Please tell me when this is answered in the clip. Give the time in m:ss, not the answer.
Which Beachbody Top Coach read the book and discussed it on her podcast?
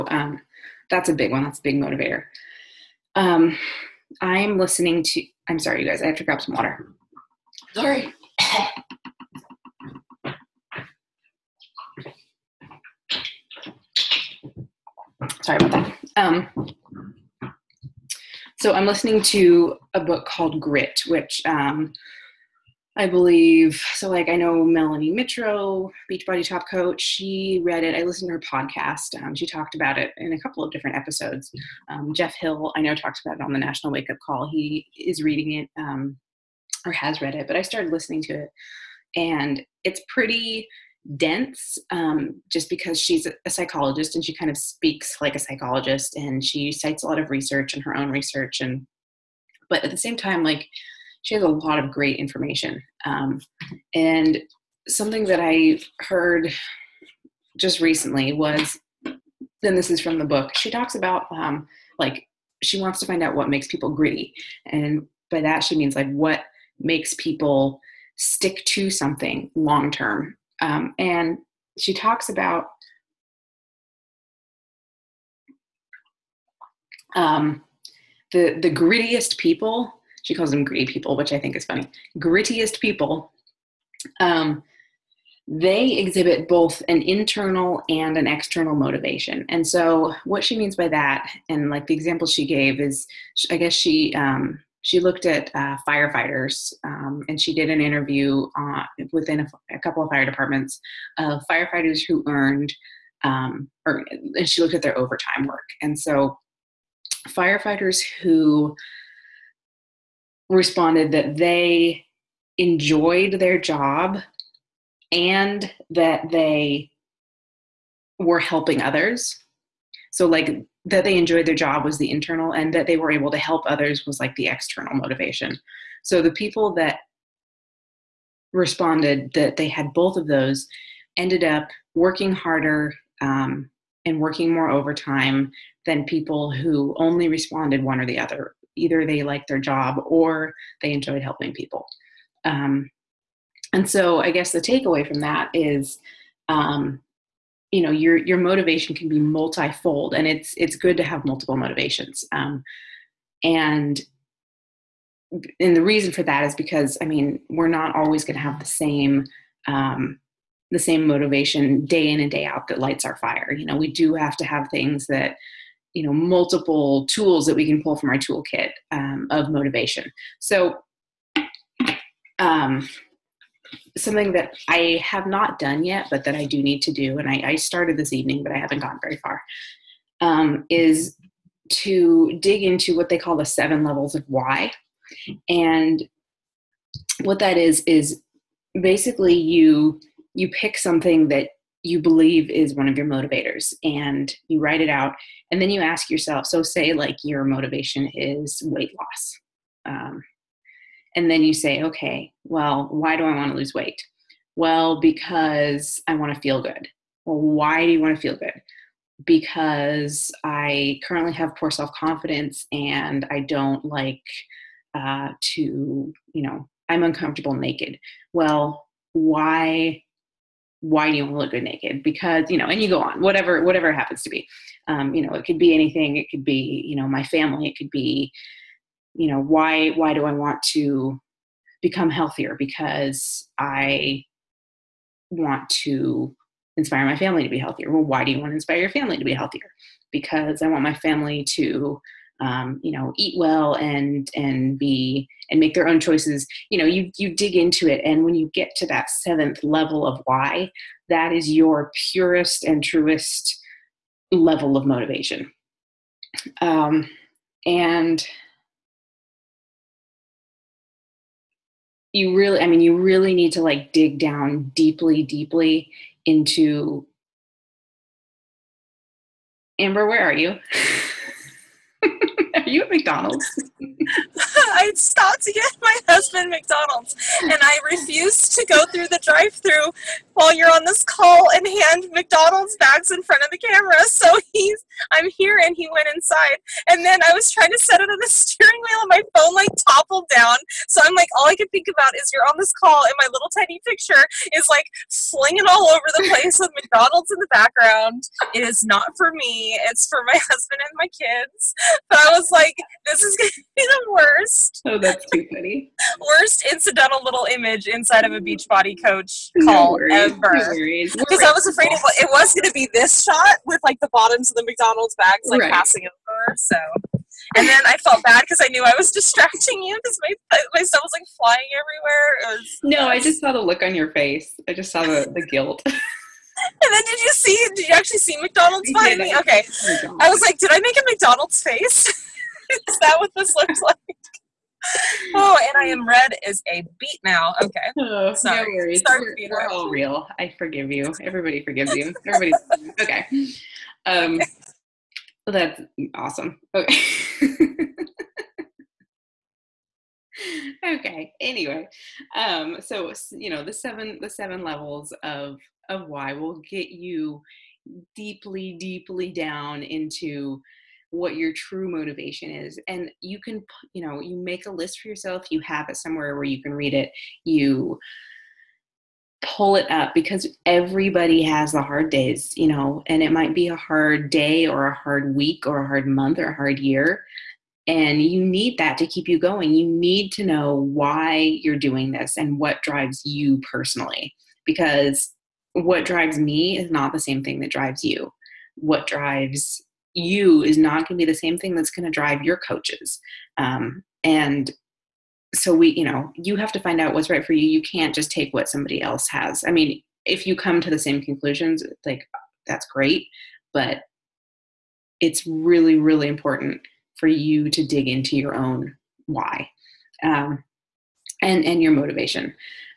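0:24.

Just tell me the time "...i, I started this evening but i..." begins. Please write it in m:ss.
2:57.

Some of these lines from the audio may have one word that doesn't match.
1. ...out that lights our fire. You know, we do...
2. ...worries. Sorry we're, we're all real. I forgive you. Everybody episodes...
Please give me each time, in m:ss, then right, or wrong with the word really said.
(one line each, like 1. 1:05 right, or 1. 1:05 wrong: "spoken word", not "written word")
1. 2:42 right
2. 5:38 wrong: "forgives", not "episodes".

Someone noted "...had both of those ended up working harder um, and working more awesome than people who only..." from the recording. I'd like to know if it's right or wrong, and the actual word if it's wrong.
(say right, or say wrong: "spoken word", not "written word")
wrong: "overtime", not "awesome".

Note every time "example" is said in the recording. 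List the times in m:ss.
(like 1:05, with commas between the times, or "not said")
1:31.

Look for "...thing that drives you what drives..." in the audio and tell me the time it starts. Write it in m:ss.
6:27.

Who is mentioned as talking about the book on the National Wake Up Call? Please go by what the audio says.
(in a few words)
Jeff Hill.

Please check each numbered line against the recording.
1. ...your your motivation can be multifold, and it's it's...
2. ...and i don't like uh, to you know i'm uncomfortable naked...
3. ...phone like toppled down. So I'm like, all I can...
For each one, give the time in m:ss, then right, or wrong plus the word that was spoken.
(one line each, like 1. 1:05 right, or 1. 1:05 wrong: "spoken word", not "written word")
1. 2:27 right
2. 3:32 right
3. 4:49 right.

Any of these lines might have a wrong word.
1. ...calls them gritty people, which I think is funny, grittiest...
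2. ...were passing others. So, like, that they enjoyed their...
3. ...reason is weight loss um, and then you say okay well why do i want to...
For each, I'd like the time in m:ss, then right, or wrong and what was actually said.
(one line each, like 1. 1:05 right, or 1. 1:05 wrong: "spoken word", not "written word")
1. 1:20 right
2. 1:58 wrong: "helping", not "passing"
3. 3:17 wrong: "motivation", not "reason".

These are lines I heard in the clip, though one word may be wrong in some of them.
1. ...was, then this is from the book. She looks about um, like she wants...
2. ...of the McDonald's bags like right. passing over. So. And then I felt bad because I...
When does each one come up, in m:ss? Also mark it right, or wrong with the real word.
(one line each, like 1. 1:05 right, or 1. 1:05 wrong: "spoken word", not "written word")
1. 0:58 wrong: "talks", not "looks"
2. 5:14 right.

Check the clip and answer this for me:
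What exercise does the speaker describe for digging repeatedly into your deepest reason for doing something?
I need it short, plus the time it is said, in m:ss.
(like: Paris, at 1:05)
Seven levels of why, at 3:03.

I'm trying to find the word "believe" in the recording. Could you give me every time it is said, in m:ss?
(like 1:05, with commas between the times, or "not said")
0:23, 3:12.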